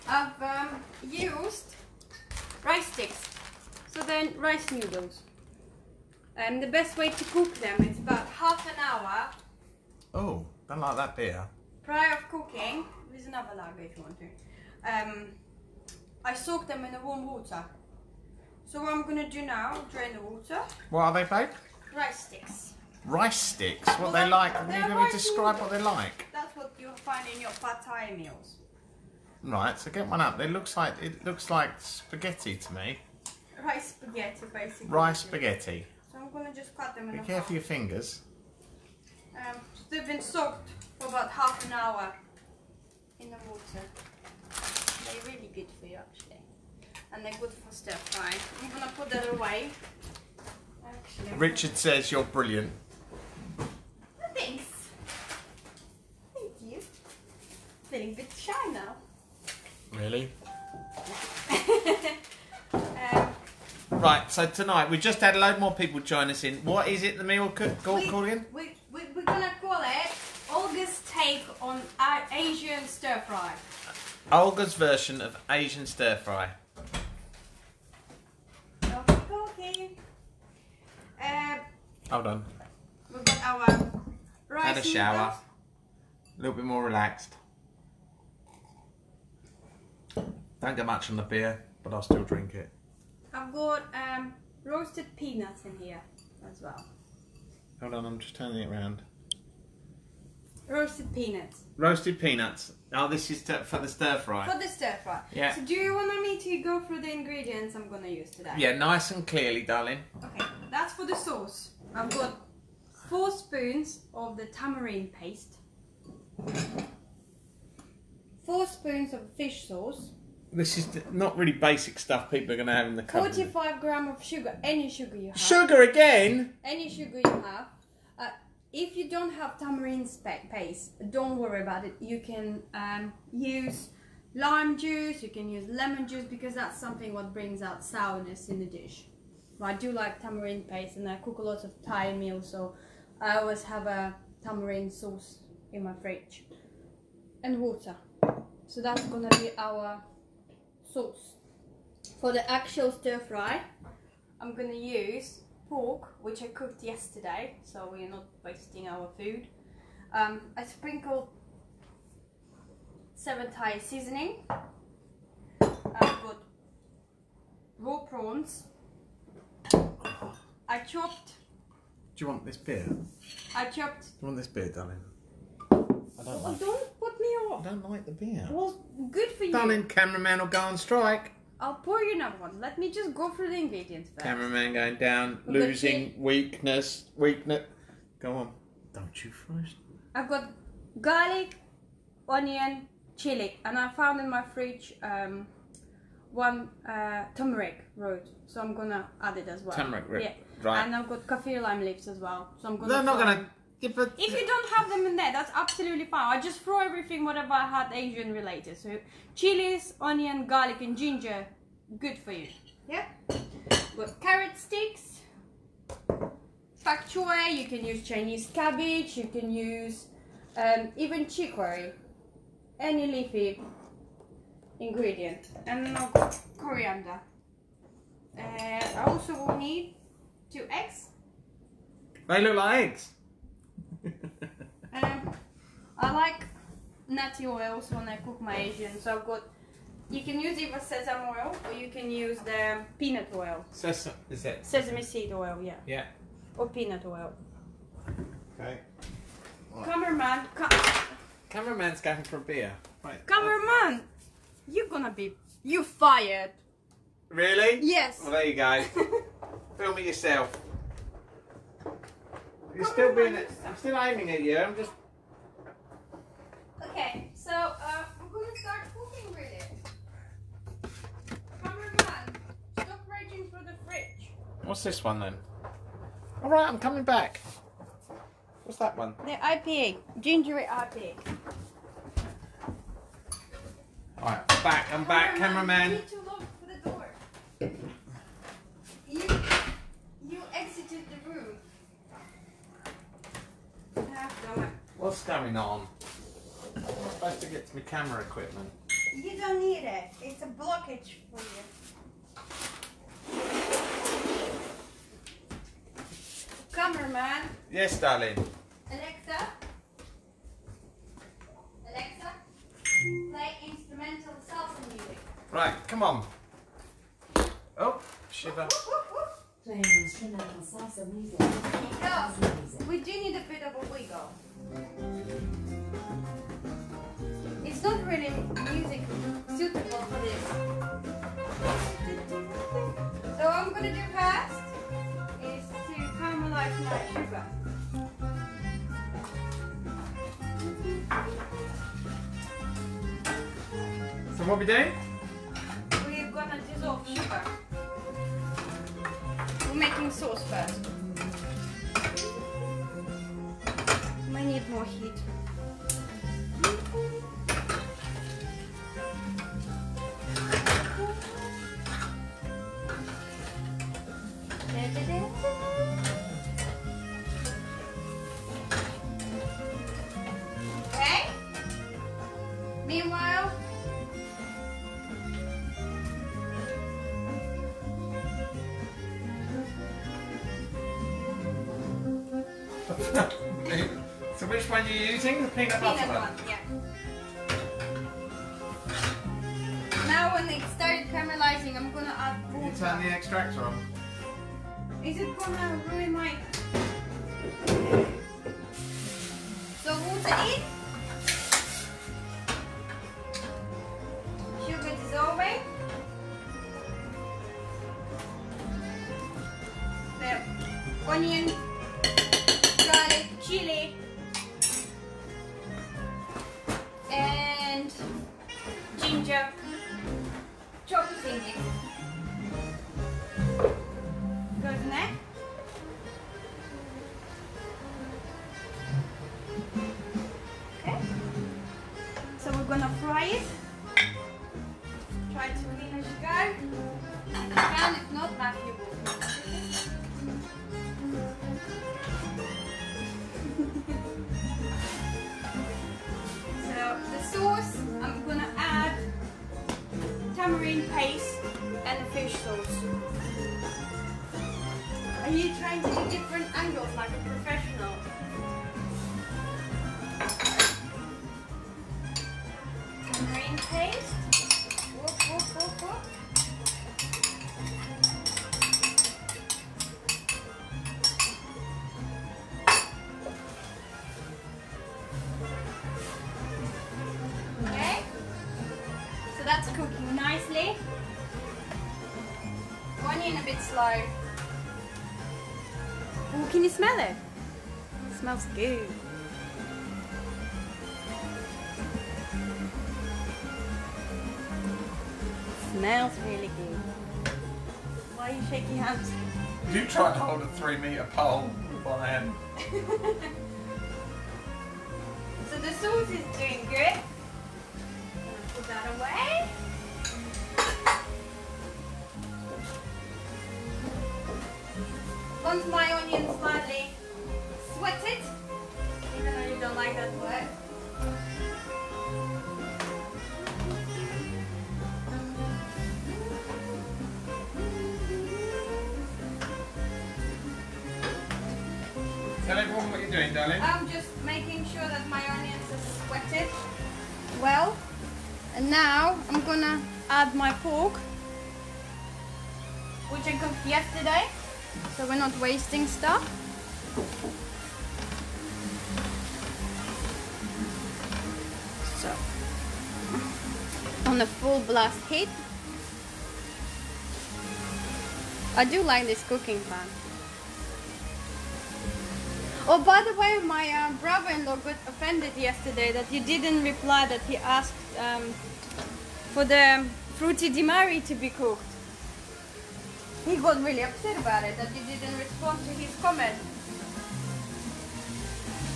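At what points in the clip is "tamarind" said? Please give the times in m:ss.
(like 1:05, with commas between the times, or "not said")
1:54, 2:09, 2:20, 2:24.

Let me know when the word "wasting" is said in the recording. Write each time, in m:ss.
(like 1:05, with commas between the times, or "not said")
2:38, 9:05.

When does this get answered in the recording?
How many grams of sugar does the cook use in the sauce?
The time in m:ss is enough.
2:03.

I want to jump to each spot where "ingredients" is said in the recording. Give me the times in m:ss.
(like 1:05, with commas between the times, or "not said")
1:47, 3:03, 3:44.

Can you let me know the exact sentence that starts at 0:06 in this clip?
Um, the best way to cook them is about half an hour.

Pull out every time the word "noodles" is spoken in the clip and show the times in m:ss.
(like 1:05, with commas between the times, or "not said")
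0:04, 0:25.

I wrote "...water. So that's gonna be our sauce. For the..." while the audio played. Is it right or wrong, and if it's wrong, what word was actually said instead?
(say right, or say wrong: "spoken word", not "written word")
right.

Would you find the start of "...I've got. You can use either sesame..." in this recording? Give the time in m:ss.
3:59.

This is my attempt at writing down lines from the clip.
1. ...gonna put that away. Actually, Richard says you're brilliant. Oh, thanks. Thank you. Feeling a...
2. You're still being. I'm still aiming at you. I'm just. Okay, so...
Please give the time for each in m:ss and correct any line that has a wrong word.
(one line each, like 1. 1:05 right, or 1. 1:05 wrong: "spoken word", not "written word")
1. 0:48 right
2. 4:22 right.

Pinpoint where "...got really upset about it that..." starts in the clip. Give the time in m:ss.
9:33.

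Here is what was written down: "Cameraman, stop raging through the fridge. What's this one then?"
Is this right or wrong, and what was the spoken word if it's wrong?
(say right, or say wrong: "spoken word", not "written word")
right.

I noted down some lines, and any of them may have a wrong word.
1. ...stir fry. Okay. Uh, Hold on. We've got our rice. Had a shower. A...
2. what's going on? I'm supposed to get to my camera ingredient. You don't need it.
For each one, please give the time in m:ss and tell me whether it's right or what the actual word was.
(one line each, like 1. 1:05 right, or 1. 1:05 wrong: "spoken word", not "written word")
1. 1:15 right
2. 4:55 wrong: "equipment", not "ingredient".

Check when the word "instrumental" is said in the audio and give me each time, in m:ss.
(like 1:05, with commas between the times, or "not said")
5:13, 5:19.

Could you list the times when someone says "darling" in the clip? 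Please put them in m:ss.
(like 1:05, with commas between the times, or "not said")
1:49, 2:54, 2:59, 5:07, 8:53.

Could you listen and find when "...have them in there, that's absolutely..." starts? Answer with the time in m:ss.
3:24.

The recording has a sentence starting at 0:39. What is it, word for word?
Um, they've been soaked for about half an hour in the water.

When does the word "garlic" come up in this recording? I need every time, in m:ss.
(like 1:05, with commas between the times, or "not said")
3:11, 3:30.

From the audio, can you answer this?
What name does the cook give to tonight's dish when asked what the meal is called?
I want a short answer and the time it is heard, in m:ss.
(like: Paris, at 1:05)
Olga's take on Asian stir fry, at 1:10.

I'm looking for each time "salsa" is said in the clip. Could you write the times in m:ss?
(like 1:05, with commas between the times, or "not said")
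5:14, 5:20.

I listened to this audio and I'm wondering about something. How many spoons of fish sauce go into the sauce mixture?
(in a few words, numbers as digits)
4.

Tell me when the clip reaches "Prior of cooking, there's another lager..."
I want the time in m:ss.
0:11.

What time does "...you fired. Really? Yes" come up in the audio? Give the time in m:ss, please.
4:15.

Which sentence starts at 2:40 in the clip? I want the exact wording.
Um, I sprinkled seven Thai seasoning.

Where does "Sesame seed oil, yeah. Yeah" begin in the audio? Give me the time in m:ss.
4:04.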